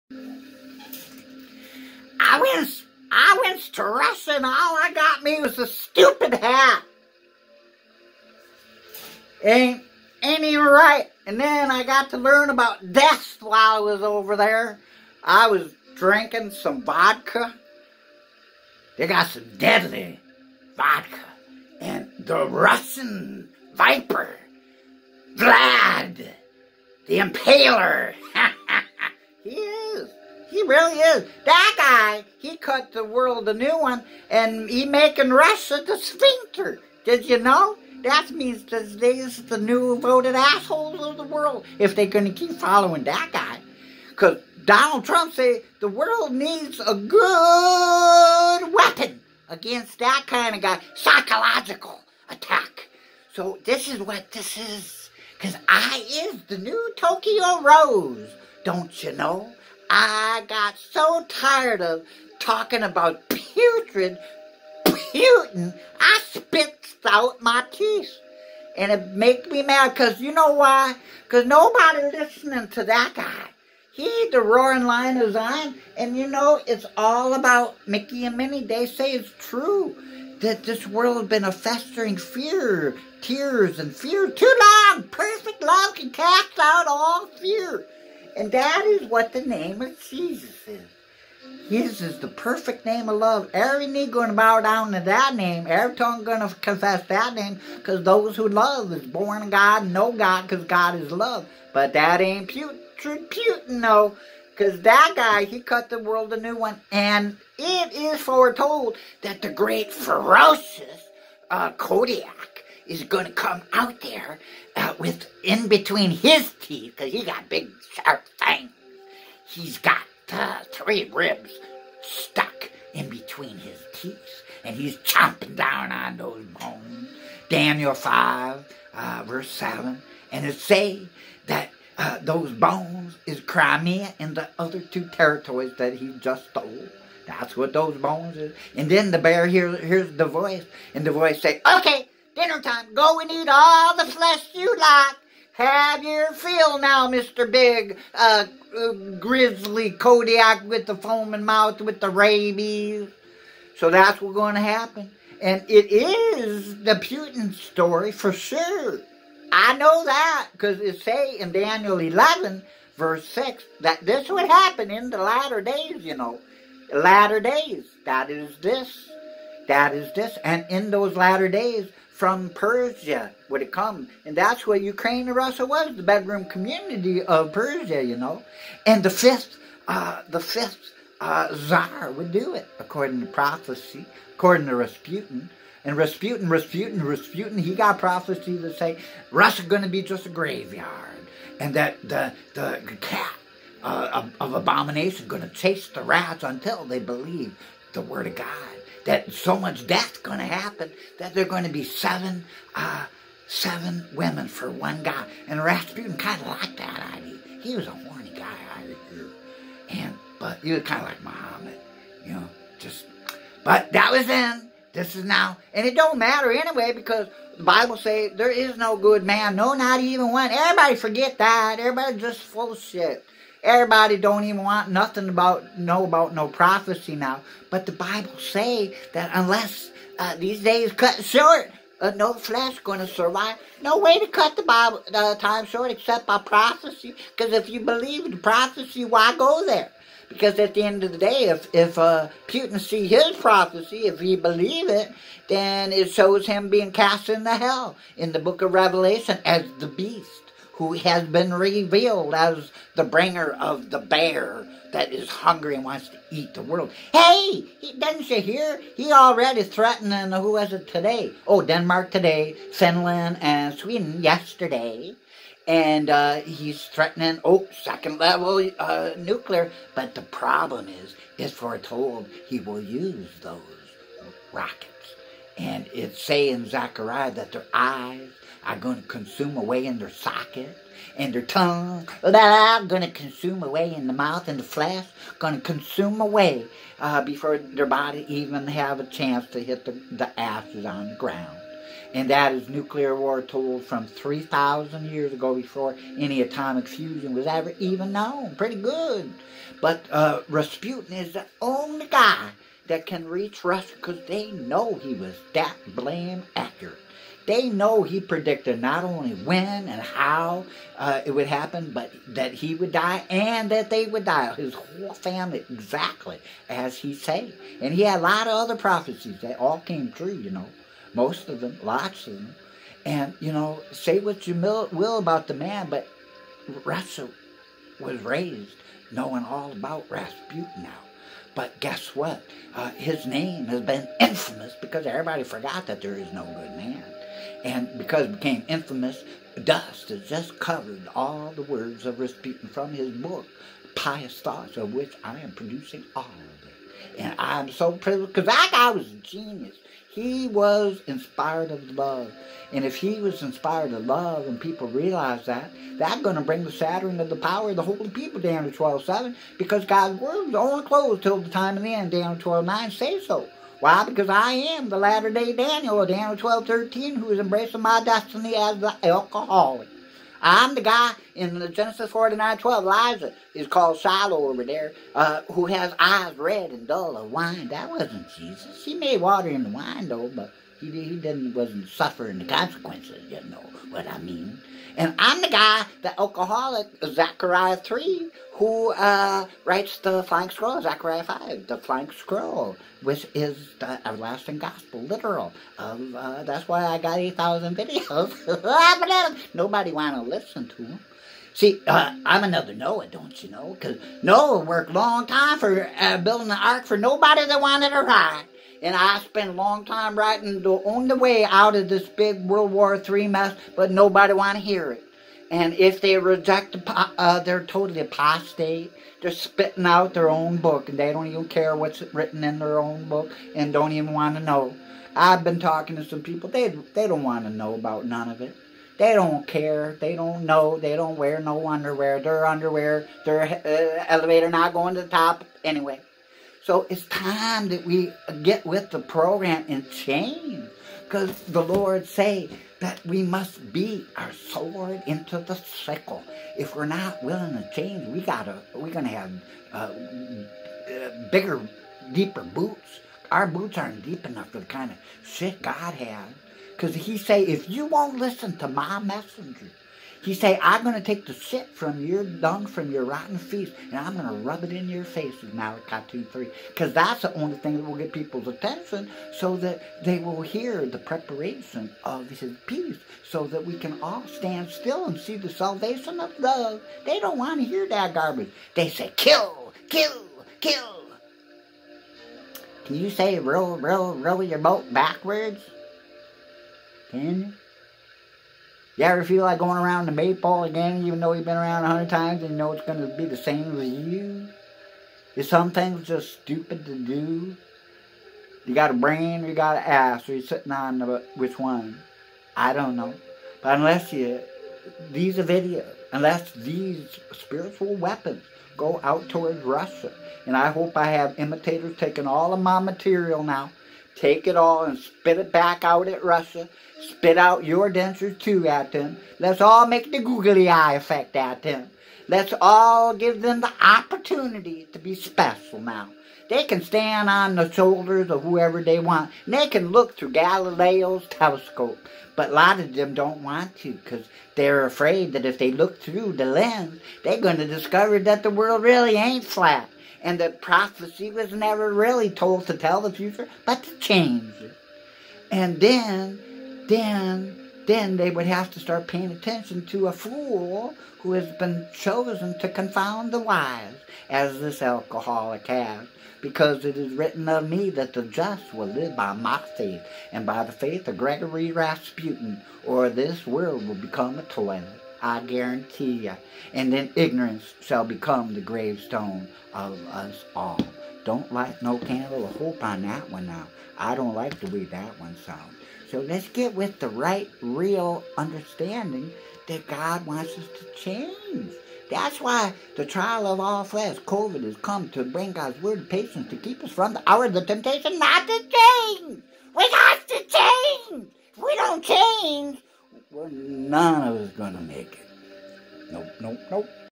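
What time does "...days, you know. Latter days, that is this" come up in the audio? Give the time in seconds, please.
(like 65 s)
165 s.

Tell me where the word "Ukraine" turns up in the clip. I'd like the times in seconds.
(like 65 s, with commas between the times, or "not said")
174 s.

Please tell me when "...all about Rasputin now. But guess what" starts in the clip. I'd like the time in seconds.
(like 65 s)
329 s.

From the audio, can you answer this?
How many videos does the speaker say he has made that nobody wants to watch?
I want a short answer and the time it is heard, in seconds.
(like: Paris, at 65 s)
8,000, at 397 s.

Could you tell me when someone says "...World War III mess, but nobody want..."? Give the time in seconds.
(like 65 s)
412 s.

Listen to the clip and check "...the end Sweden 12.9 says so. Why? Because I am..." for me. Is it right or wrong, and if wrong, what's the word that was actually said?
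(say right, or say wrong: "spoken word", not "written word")
wrong: "Daniel", not "Sweden".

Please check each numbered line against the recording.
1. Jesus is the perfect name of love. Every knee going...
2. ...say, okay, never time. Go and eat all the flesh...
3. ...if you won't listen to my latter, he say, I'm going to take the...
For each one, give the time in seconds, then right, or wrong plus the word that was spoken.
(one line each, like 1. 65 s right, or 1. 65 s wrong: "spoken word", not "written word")
1. 91 s right
2. 141 s wrong: "dinner", not "never"
3. 457 s wrong: "messenger", not "latter".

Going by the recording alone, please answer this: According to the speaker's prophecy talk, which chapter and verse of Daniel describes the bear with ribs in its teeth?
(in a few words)
Daniel 5, verse 7.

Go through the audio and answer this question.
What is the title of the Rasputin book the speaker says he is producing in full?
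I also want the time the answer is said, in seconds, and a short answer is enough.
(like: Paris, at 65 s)
Pious Thoughts, at 343 s.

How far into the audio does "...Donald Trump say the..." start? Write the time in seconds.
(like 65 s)
44 s.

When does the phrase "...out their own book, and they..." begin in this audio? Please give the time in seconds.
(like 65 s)
419 s.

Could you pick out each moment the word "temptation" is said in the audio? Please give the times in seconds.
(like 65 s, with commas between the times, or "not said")
587 s.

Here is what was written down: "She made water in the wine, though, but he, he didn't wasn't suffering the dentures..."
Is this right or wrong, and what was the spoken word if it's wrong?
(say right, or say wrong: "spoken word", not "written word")
wrong: "consequences", not "dentures".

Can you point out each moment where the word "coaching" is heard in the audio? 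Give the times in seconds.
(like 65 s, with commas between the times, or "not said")
not said.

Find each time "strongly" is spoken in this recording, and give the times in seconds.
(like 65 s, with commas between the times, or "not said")
not said.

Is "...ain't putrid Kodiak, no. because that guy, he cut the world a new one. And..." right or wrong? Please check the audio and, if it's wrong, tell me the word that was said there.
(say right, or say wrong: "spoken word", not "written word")
wrong: "Putin", not "Kodiak".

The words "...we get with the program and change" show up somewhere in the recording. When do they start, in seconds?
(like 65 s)
437 s.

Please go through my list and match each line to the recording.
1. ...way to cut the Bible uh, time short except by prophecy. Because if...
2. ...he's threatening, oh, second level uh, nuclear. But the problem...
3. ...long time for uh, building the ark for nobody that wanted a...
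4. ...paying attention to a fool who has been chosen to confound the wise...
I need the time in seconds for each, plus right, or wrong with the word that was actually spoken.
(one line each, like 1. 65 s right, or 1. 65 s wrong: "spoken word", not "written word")
1. 233 s right
2. 266 s right
3. 404 s right
4. 549 s right.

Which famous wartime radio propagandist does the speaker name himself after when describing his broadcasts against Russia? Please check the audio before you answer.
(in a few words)
Tokyo Rose.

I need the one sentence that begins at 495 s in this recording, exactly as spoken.
Is some things just stupid to do?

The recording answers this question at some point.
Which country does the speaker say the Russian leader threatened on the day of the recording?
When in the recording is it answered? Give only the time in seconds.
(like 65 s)
261 s.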